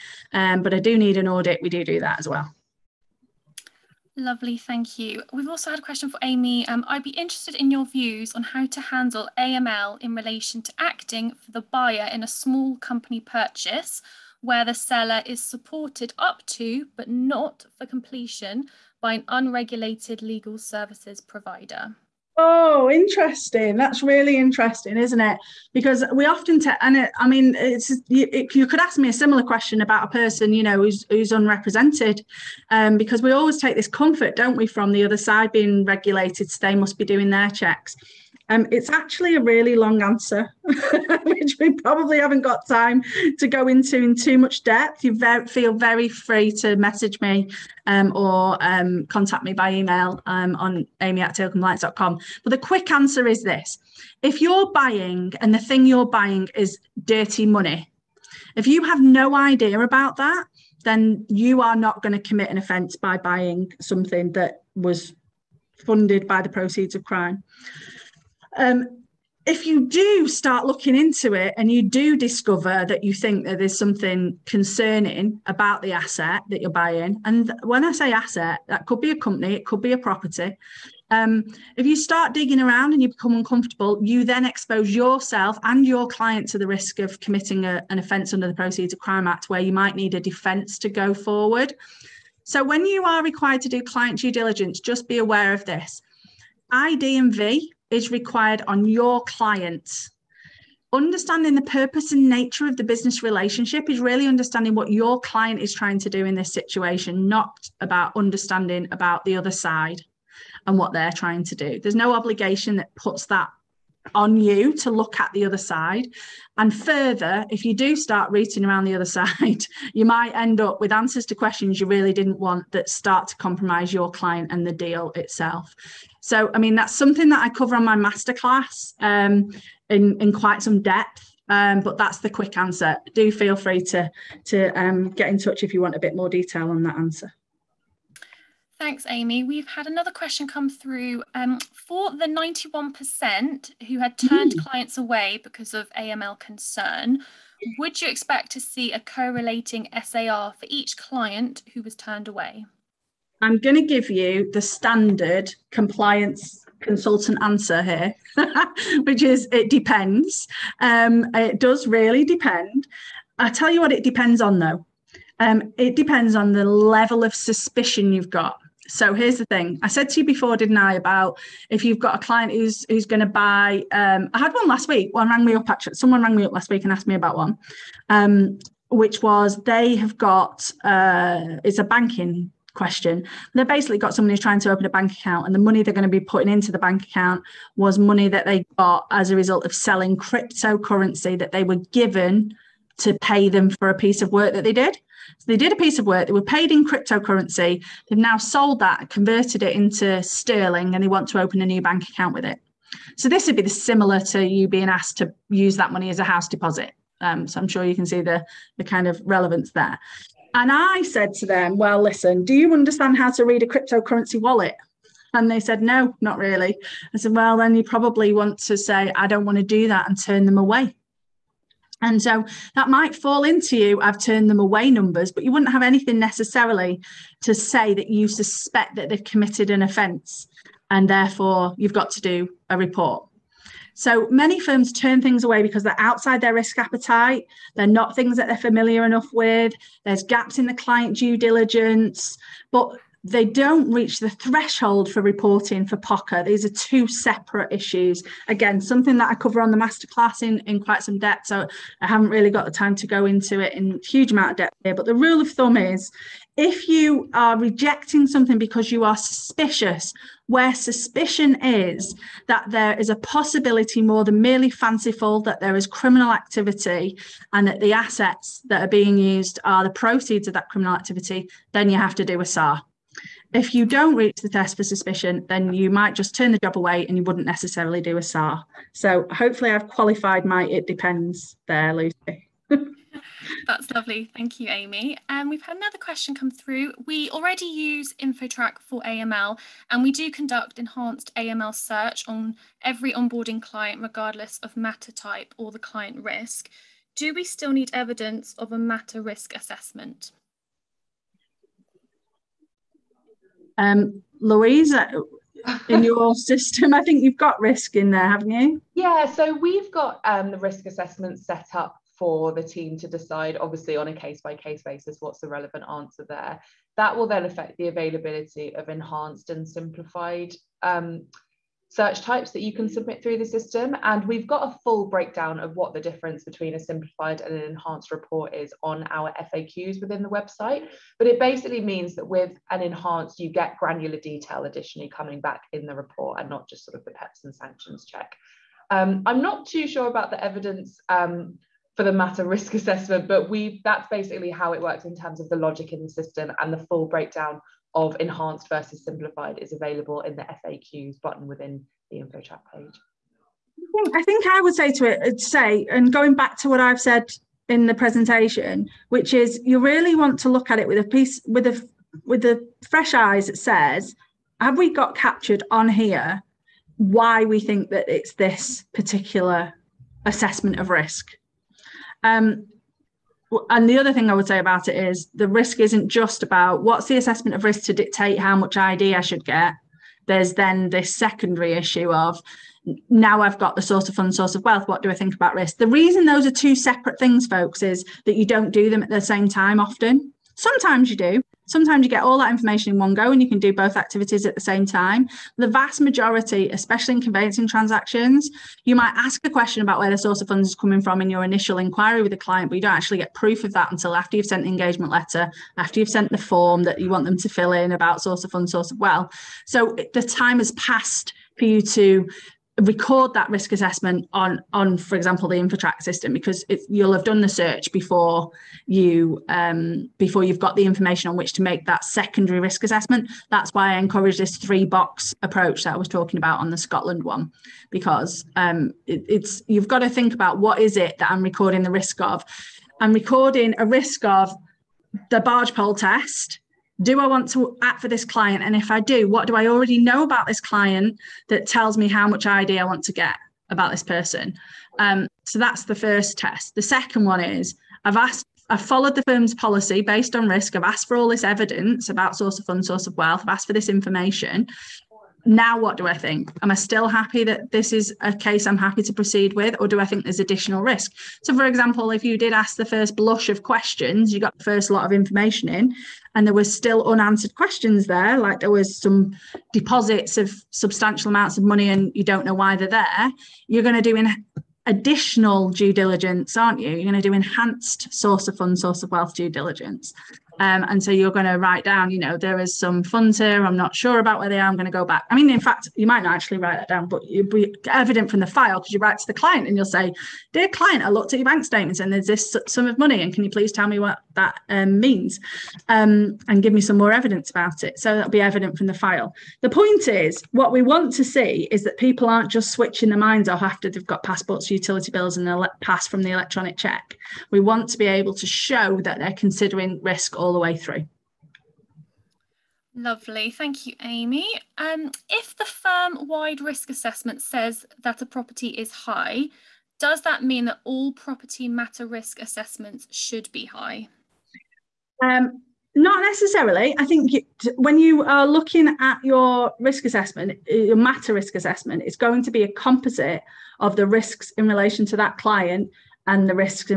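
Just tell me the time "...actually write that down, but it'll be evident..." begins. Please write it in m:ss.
8:06.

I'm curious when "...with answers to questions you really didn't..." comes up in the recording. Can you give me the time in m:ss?
2:00.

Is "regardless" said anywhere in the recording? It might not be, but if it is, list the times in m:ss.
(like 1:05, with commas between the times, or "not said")
4:54.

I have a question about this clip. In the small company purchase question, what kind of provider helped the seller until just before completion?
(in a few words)
unregulated legal services provider.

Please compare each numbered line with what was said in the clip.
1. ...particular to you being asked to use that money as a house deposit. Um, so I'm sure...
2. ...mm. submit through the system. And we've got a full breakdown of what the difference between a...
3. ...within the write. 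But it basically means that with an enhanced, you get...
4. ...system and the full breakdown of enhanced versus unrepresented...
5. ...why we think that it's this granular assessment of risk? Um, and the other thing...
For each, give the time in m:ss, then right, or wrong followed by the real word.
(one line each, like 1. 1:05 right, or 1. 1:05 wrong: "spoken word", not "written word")
1. 3:23 wrong: "similar", not "particular"
2. 5:22 right
3. 5:30 wrong: "website", not "write"
4. 5:46 wrong: "simplified", not "unrepresented"
5. 6:06 wrong: "particular", not "granular".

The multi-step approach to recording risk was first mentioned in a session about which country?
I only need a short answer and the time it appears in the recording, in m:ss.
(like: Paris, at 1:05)
Scotland, at 7:06.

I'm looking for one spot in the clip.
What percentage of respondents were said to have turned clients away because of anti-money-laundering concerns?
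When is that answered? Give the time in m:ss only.
2:22.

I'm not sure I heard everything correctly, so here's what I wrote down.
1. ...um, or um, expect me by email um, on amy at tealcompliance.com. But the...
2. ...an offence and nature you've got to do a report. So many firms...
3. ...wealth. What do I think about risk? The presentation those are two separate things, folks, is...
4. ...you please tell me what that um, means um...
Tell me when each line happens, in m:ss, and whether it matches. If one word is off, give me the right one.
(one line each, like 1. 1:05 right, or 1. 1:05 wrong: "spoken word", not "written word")
1. 0:47 wrong: "contact", not "expect"
2. 3:49 wrong: "therefore", not "nature"
3. 6:24 wrong: "reason", not "presentation"
4. 8:13 right.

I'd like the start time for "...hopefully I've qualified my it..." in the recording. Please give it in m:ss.
4:39.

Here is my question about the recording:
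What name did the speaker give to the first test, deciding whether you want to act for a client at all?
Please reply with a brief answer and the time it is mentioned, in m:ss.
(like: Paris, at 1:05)
the barge pole test, at 7:15.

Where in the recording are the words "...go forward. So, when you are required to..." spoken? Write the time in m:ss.
1:30.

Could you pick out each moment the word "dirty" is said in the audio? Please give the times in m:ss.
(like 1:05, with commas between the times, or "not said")
0:57.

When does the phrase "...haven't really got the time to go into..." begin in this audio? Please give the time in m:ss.
4:12.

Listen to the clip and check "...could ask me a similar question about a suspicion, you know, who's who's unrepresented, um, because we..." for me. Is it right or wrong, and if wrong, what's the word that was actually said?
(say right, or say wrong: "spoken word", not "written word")
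wrong: "person", not "suspicion".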